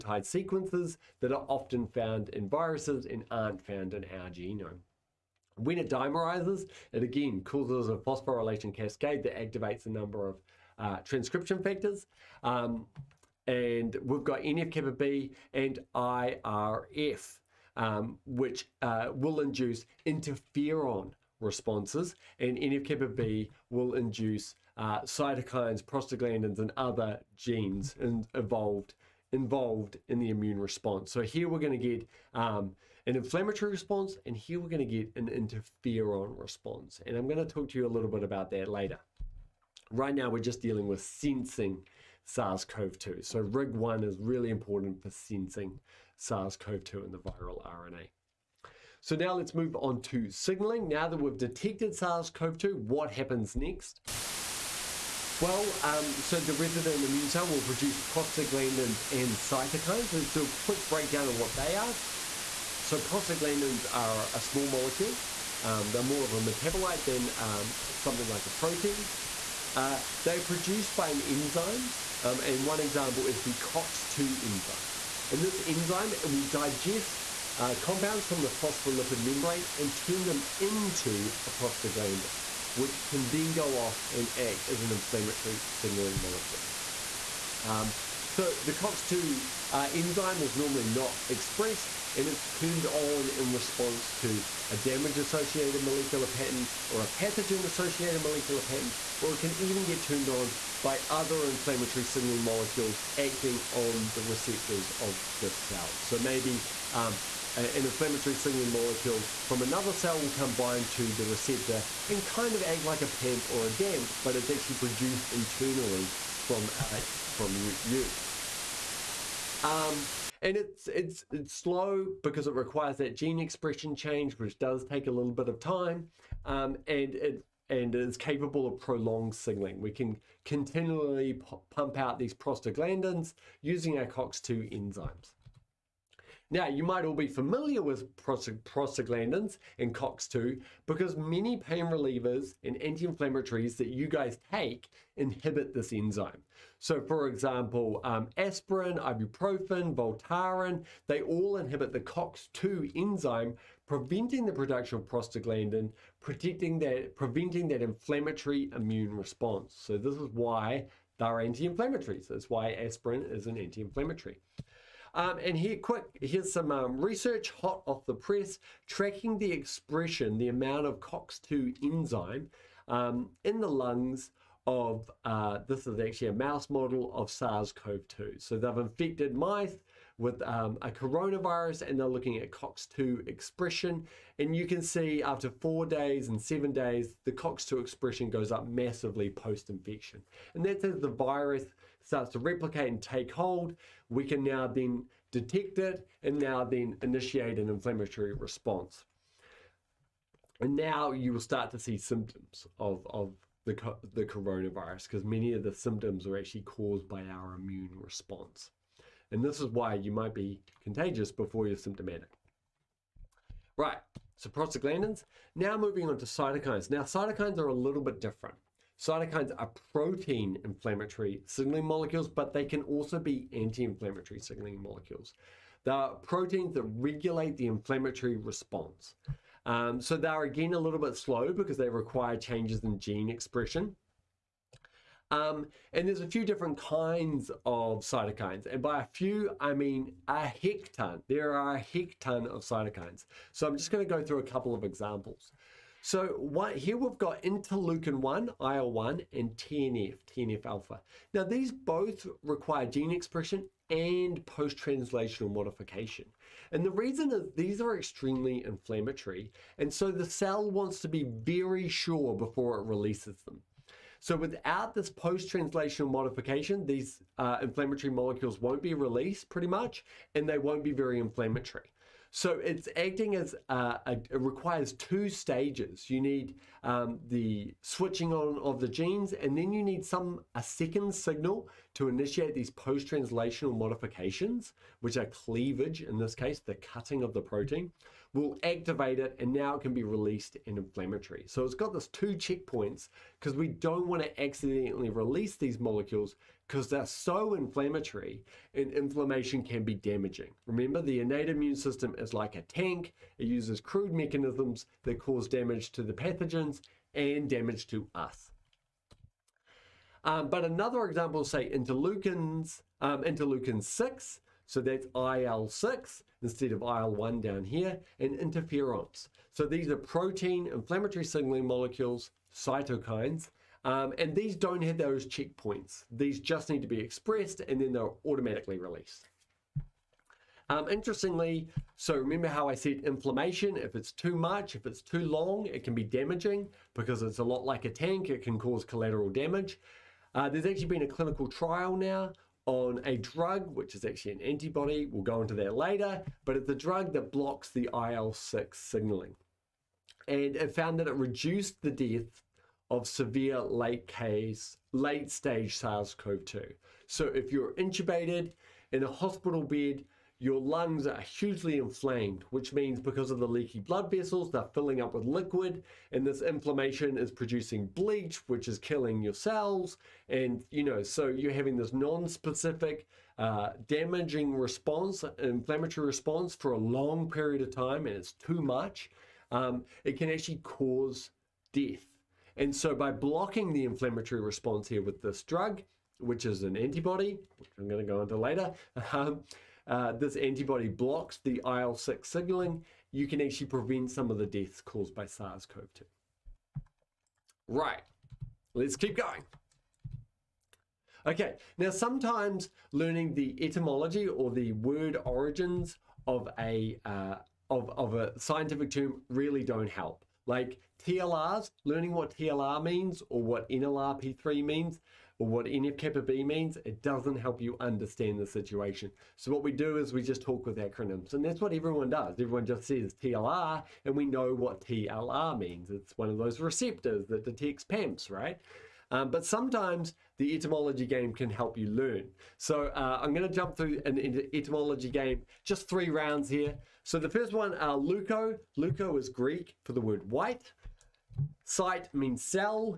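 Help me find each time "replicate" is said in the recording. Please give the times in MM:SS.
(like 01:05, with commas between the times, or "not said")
03:12.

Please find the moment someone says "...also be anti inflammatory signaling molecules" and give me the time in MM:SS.
03:42.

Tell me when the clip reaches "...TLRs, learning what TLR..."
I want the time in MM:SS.
06:51.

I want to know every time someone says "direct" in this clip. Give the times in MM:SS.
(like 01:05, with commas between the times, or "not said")
not said.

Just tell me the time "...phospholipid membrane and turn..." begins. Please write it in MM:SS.
01:18.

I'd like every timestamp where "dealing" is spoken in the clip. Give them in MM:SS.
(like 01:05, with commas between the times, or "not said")
00:40.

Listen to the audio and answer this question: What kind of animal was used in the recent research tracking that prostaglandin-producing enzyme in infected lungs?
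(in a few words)
Mouse.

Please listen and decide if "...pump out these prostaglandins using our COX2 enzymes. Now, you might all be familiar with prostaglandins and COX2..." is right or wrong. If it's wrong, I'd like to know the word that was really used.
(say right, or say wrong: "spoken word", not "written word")
right.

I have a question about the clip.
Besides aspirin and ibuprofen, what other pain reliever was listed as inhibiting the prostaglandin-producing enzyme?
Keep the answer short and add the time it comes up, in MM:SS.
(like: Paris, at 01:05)
Voltaren, at 02:29.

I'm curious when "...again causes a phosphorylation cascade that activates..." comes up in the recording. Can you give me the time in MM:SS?
00:07.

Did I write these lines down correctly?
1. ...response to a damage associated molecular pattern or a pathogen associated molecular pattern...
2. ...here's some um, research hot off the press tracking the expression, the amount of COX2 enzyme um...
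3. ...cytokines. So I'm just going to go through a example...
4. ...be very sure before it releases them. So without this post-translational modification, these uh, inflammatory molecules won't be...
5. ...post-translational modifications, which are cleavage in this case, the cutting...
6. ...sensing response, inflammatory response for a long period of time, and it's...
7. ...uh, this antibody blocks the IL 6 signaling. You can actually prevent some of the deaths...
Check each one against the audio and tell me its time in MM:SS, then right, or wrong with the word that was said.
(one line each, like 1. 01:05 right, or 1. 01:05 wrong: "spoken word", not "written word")
1. 01:33 right
2. 02:46 right
3. 04:02 wrong: "couple", not "example"
4. 04:21 right
5. 04:42 right
6. 06:13 wrong: "damaging", not "sensing"
7. 06:29 right.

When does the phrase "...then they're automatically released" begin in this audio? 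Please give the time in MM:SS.
05:27.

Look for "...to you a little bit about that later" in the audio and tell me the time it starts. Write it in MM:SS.
00:37.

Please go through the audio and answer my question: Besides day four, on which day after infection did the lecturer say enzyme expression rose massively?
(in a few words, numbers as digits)
7.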